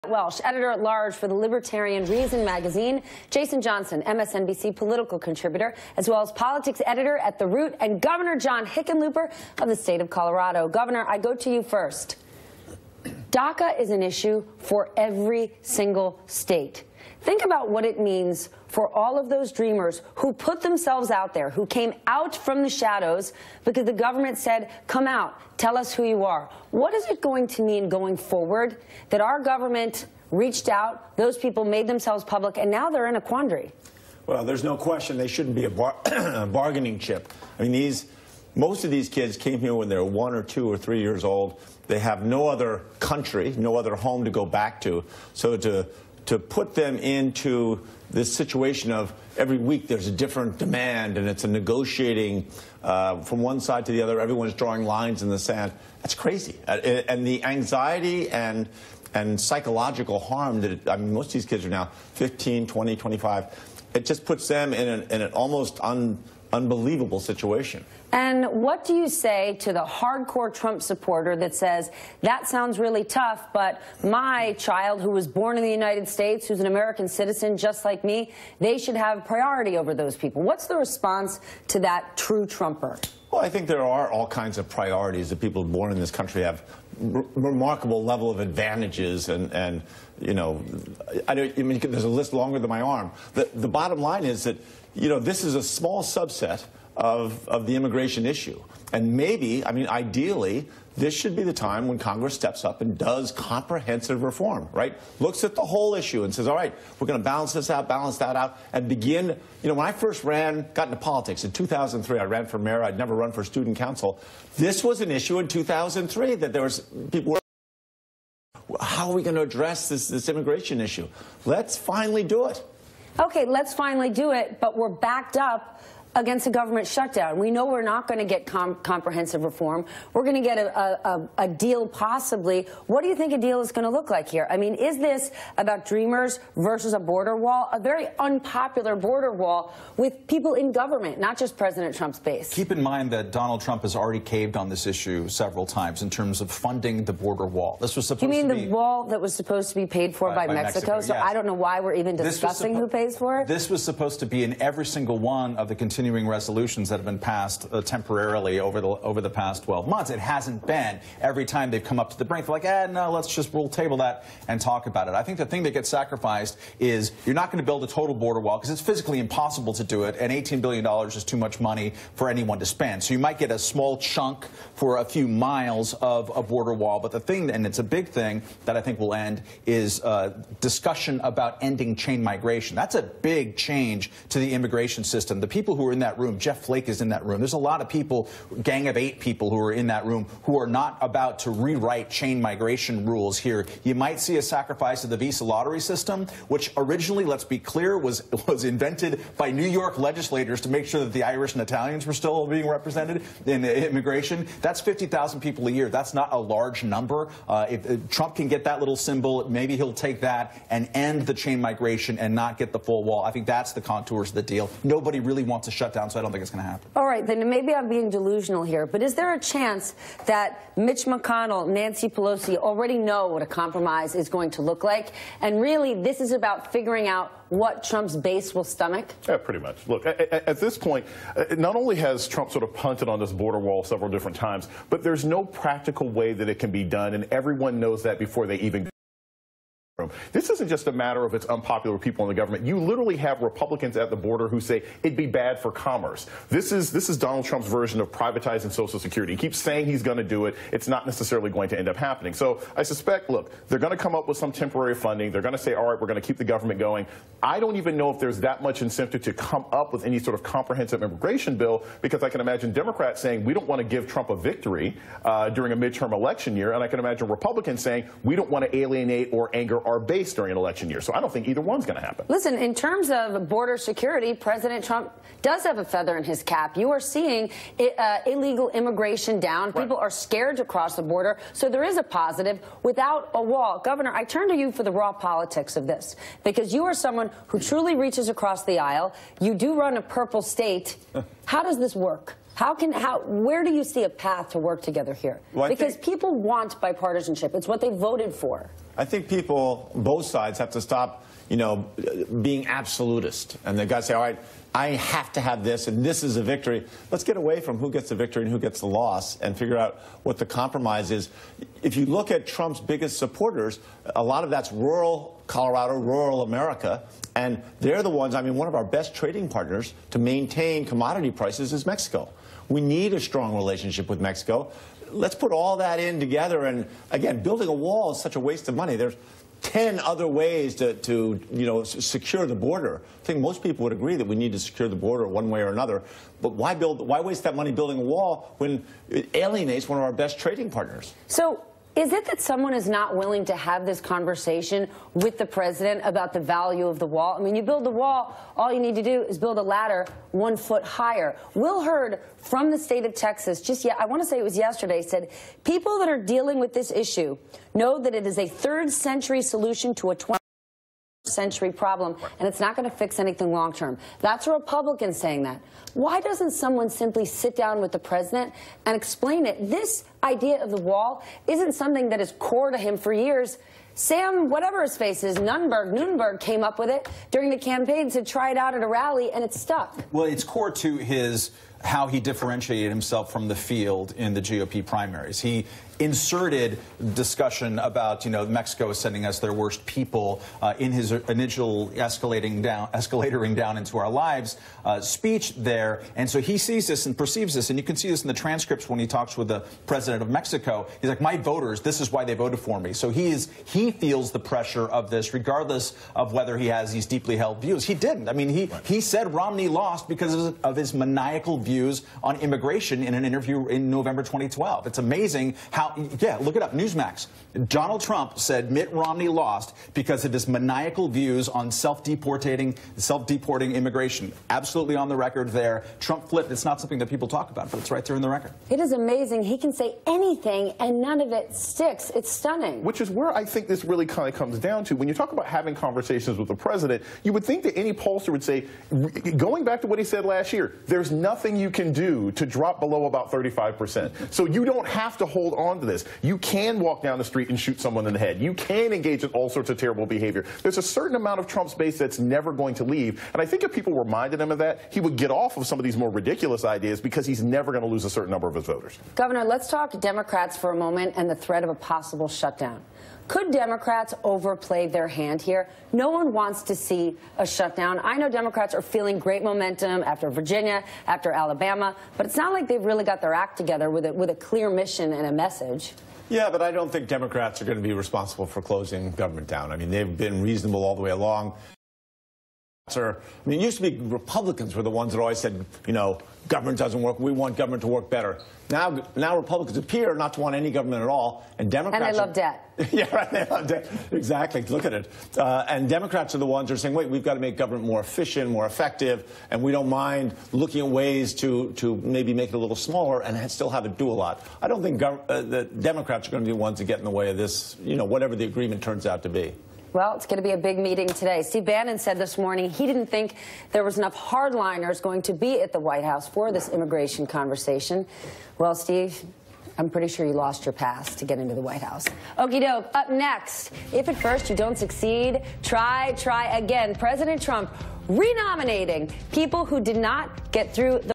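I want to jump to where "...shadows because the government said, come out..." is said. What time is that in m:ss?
0:22.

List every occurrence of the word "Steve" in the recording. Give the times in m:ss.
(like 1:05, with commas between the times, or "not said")
8:31, 8:38.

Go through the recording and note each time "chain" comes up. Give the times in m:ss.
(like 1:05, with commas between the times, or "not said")
3:01, 3:12, 3:31.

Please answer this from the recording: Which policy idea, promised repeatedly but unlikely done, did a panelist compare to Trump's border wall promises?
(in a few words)
privatizing Social Security.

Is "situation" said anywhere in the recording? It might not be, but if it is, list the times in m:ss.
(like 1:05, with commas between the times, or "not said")
0:48, 1:07.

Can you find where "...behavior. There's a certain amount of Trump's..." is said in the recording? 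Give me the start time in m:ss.
7:30.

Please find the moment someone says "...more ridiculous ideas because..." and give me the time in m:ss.
7:35.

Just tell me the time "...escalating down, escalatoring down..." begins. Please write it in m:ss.
6:31.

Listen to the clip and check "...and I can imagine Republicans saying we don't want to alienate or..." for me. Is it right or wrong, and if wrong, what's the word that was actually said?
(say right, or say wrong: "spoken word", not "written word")
right.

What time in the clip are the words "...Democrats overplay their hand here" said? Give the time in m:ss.
7:43.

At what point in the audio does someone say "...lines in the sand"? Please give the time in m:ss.
0:54.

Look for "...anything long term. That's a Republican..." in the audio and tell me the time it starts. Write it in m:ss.
6:03.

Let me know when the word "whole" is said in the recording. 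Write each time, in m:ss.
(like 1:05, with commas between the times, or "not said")
1:45.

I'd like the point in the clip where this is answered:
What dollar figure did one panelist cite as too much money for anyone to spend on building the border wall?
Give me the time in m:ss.
2:50.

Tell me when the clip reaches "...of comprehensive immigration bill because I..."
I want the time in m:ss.
4:20.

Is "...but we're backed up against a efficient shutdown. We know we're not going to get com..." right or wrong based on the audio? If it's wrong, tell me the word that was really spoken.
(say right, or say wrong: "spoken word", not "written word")
wrong: "government", not "efficient".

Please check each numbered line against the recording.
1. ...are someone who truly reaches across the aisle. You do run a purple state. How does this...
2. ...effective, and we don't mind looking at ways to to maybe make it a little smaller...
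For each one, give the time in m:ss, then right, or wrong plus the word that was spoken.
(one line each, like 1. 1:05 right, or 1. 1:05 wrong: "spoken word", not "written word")
1. 4:46 right
2. 8:18 right.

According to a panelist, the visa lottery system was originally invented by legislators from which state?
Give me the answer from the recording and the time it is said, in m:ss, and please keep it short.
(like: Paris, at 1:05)
New York, at 3:19.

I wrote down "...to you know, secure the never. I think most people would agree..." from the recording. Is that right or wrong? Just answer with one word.
wrong.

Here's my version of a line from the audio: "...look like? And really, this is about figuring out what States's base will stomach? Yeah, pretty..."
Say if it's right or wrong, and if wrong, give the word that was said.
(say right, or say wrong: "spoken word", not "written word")
wrong: "Trump", not "States".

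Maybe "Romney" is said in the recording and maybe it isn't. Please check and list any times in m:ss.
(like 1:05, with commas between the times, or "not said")
6:49, 6:58.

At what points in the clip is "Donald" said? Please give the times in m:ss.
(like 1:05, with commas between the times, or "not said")
2:23, 4:07, 6:57.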